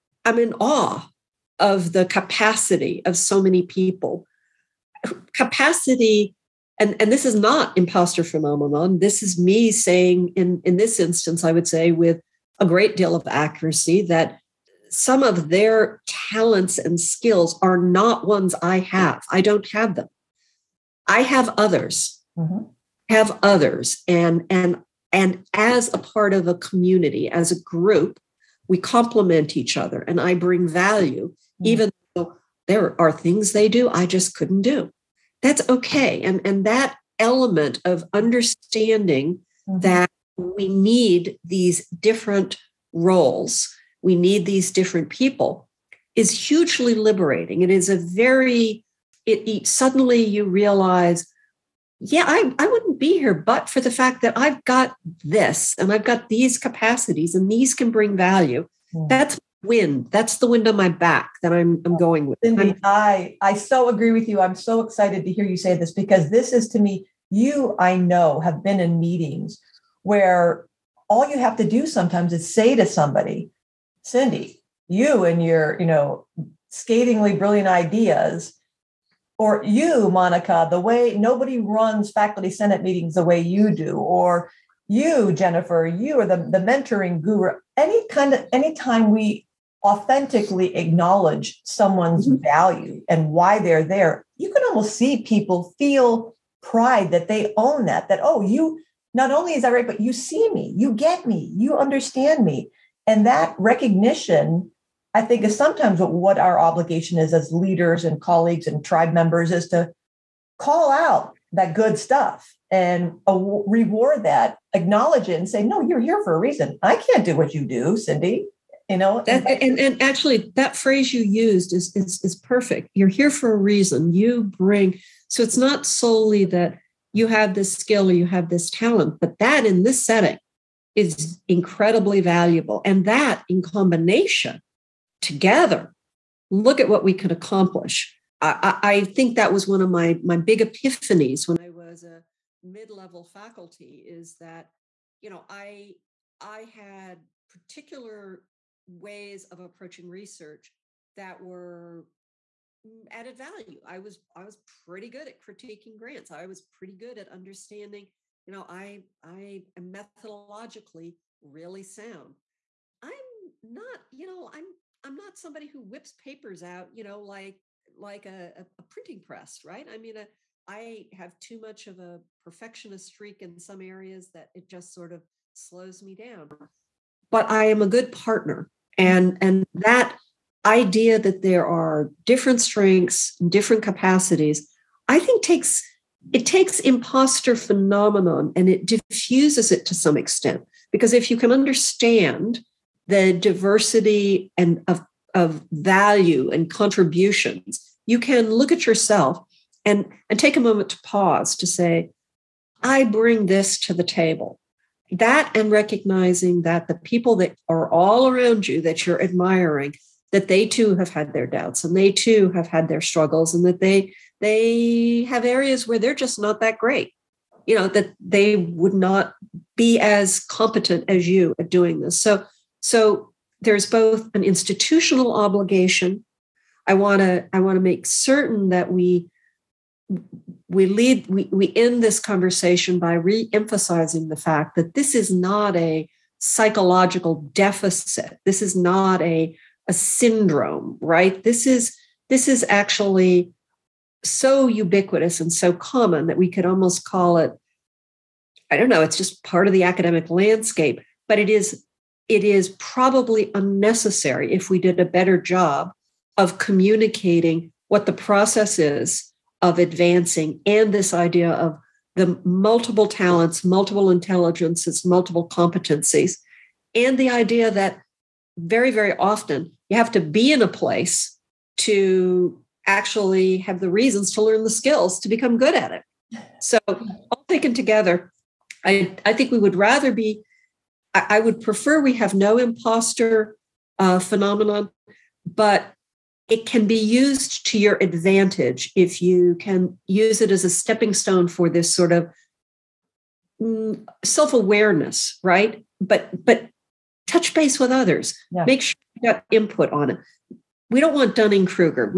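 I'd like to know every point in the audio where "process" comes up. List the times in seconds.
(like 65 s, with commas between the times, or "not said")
258 s.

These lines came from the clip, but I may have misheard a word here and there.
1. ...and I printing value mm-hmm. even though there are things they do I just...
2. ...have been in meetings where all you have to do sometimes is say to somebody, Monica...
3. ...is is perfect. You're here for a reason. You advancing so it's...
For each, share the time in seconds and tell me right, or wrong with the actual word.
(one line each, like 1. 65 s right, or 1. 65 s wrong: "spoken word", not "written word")
1. 30 s wrong: "bring", not "printing"
2. 68 s wrong: "Cindy", not "Monica"
3. 121 s wrong: "bring", not "advancing".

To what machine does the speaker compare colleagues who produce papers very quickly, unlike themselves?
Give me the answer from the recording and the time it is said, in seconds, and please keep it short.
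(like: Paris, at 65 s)
a printing press, at 168 s.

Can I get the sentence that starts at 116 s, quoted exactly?
I can't do what you do, Cindy.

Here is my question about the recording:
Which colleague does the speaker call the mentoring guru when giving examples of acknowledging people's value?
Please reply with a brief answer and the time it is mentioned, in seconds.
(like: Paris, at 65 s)
Jennifer, at 85 s.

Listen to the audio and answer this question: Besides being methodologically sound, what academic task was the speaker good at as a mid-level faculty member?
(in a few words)
critiquing grants.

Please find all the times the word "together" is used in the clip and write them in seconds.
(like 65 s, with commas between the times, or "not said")
135 s, 277 s.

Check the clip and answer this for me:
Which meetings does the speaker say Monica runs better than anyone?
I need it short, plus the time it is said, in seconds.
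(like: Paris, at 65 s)
faculty senate meetings, at 82 s.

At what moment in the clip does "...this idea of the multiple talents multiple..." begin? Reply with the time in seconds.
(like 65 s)
260 s.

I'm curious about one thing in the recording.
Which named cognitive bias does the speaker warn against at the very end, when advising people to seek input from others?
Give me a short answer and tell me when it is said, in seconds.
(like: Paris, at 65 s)
Dunning Kruger, at 301 s.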